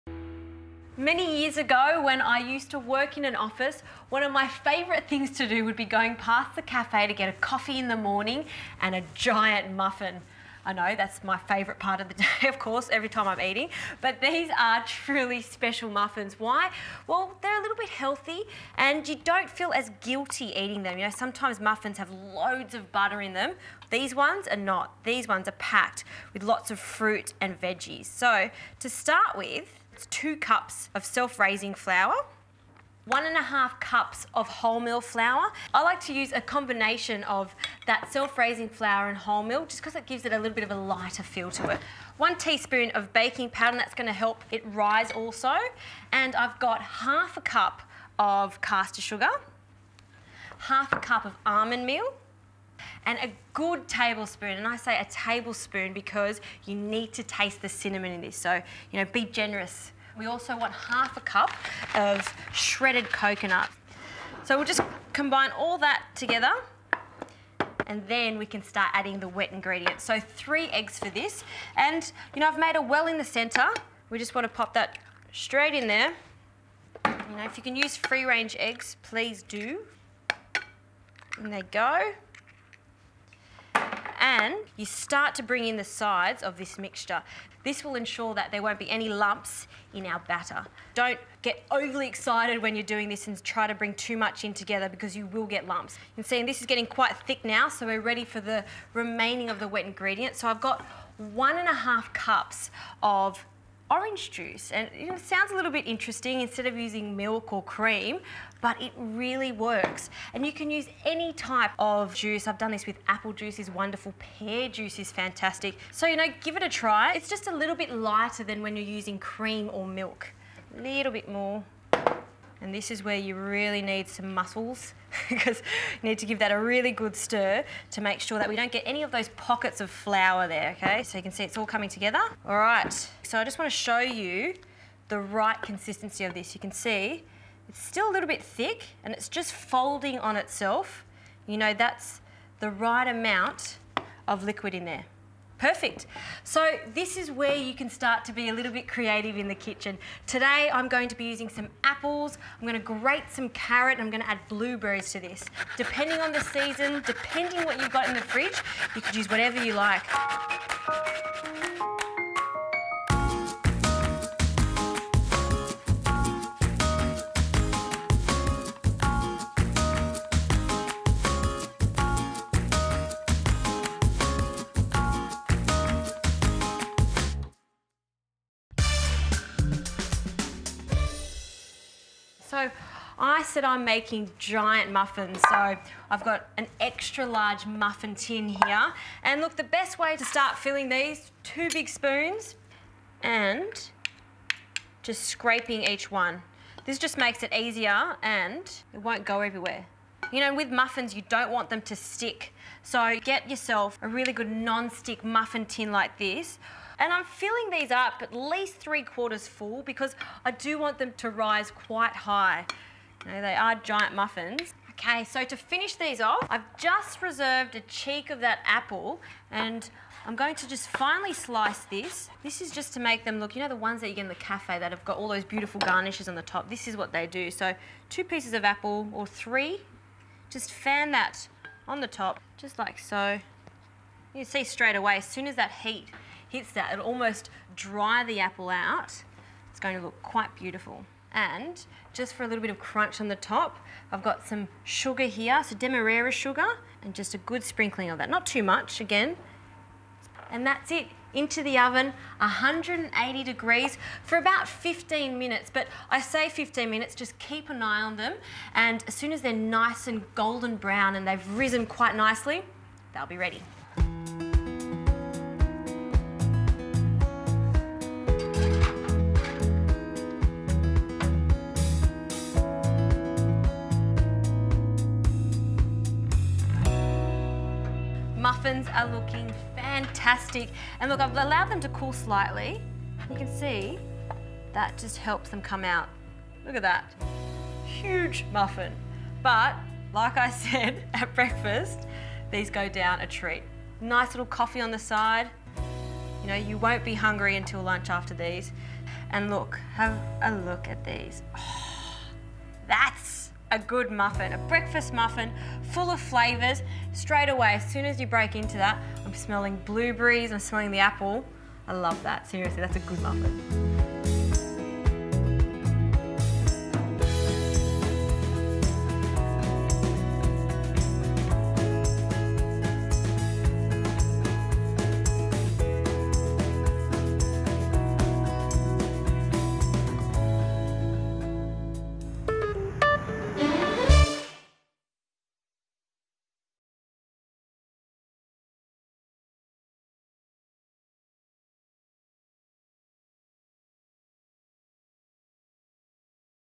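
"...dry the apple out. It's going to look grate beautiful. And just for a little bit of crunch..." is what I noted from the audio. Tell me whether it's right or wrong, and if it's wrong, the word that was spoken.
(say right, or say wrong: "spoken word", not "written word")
wrong: "quite", not "grate".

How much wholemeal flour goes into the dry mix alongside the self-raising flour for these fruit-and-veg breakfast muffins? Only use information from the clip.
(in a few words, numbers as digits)
1.5 cups.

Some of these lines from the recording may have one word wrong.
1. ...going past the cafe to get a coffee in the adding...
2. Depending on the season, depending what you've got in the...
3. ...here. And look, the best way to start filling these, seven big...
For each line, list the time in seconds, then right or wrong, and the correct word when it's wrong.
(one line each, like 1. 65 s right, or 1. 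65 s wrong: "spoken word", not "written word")
1. 5 s wrong: "morning", not "adding"
2. 155 s right
3. 188 s wrong: "two", not "seven".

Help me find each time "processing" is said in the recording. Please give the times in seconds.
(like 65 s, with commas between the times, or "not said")
not said.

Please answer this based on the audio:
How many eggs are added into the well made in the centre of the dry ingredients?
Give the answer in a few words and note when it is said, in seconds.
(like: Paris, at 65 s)
3, at 70 s.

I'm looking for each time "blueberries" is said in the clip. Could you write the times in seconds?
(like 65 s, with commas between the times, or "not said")
154 s, 309 s.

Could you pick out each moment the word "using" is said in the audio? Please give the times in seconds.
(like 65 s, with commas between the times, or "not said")
106 s, 118 s, 151 s.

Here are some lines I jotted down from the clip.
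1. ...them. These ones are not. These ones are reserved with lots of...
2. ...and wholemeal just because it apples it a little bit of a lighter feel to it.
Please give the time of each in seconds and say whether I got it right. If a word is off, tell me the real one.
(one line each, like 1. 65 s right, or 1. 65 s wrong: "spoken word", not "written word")
1. 23 s wrong: "packed", not "reserved"
2. 39 s wrong: "gives", not "apples".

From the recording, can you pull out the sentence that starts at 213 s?
You know, they are giant muffins.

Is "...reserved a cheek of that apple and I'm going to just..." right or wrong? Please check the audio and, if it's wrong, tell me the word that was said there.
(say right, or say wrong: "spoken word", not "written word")
right.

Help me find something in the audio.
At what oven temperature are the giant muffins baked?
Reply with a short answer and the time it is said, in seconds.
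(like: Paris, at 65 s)
180 degrees, at 252 s.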